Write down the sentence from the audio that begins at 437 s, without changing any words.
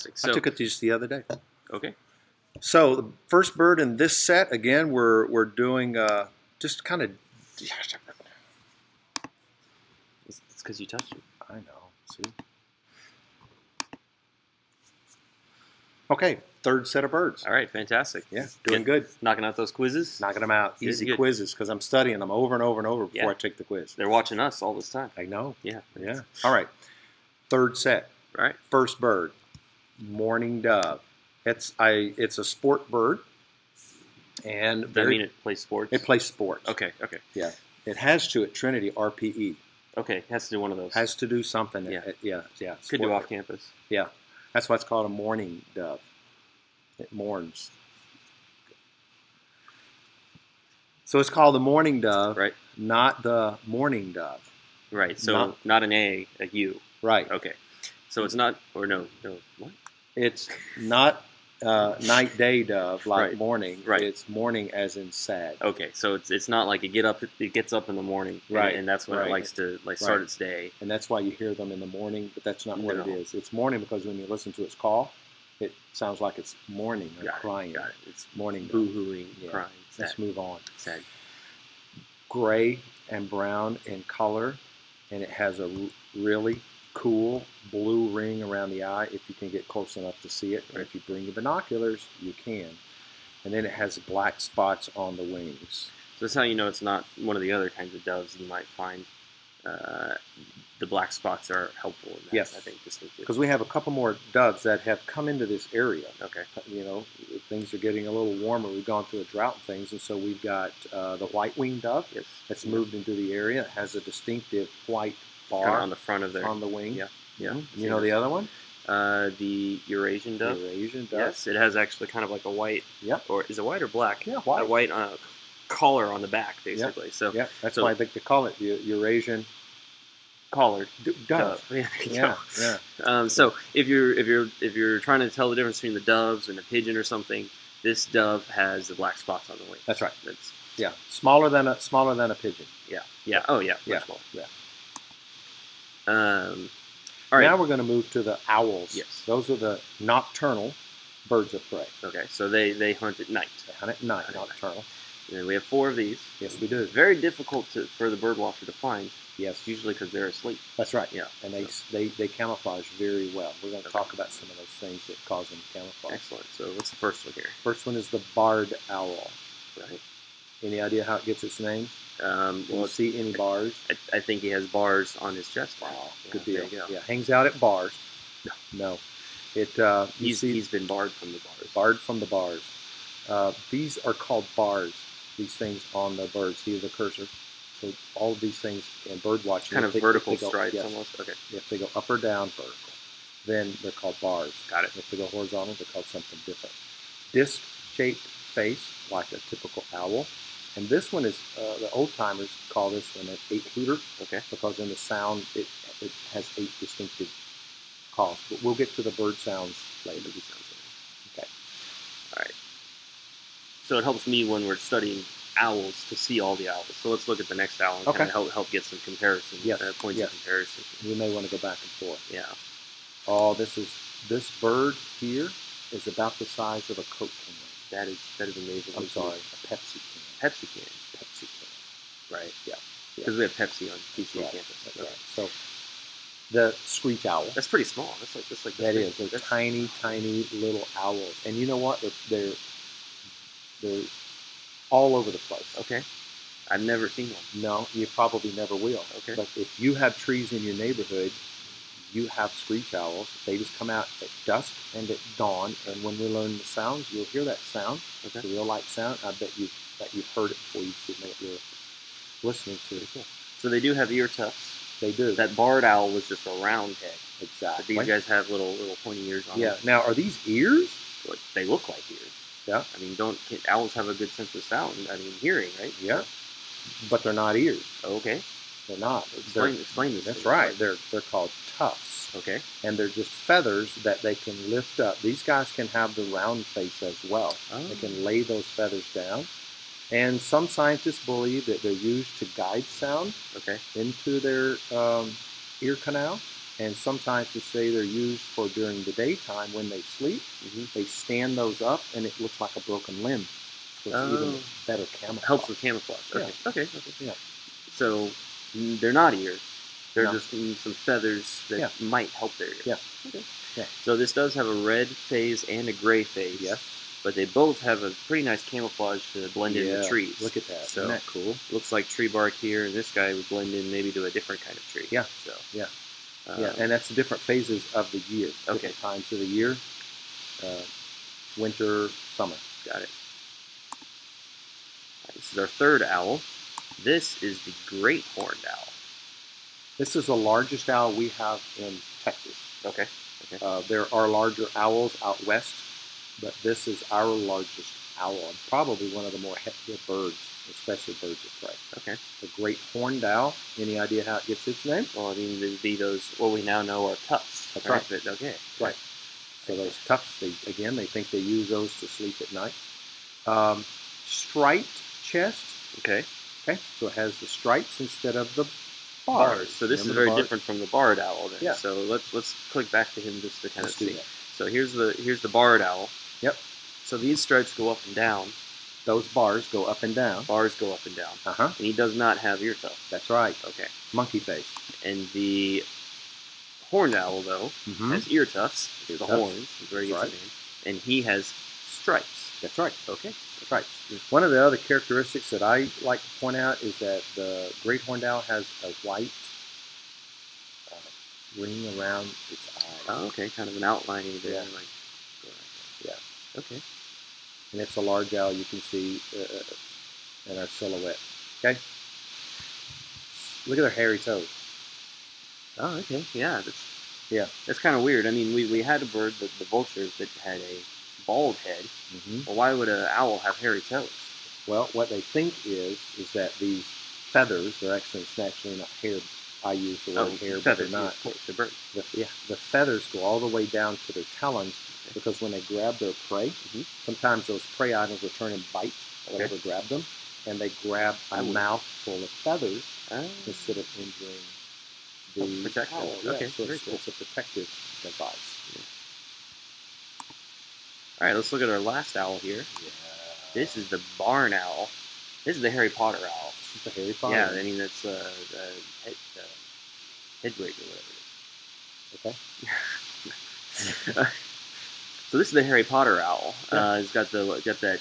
sometimes those prey items will turn and bite okay.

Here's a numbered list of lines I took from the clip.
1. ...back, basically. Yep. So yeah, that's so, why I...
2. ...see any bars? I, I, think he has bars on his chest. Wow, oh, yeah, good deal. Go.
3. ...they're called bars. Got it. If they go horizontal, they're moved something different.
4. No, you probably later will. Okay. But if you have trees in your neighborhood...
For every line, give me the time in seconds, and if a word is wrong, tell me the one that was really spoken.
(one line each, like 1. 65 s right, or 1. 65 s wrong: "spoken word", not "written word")
1. 126 s right
2. 172 s right
3. 193 s wrong: "called", not "moved"
4. 247 s wrong: "never", not "later".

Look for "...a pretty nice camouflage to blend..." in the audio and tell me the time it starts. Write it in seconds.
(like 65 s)
318 s.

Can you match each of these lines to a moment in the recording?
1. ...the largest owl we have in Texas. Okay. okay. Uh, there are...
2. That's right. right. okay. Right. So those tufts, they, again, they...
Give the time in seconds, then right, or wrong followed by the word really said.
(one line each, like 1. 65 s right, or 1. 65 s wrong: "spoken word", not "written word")
1. 340 s right
2. 357 s right.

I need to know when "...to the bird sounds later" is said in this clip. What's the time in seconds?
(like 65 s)
208 s.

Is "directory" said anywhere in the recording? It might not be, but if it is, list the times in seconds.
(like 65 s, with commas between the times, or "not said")
not said.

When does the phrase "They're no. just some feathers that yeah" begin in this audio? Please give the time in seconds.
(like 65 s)
310 s.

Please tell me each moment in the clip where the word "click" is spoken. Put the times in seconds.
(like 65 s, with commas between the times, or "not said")
372 s.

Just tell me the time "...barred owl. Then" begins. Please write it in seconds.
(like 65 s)
370 s.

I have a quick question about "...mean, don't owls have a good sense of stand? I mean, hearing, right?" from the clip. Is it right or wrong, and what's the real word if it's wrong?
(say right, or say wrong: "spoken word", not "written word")
wrong: "sound", not "stand".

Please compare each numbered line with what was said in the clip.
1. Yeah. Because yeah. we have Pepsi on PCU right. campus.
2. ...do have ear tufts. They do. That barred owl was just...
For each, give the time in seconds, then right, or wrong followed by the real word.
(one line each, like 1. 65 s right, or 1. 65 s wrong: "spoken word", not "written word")
1. 232 s right
2. 263 s right.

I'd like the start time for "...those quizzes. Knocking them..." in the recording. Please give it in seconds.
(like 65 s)
19 s.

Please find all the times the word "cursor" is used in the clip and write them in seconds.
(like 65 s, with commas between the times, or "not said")
186 s.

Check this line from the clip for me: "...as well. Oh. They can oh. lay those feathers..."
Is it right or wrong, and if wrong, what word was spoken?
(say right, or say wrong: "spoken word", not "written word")
right.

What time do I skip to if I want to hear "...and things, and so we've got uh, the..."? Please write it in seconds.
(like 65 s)
109 s.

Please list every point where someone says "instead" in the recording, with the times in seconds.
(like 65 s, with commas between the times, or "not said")
368 s, 443 s.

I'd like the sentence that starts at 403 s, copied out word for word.
Oh, okay, kind of an outlining there.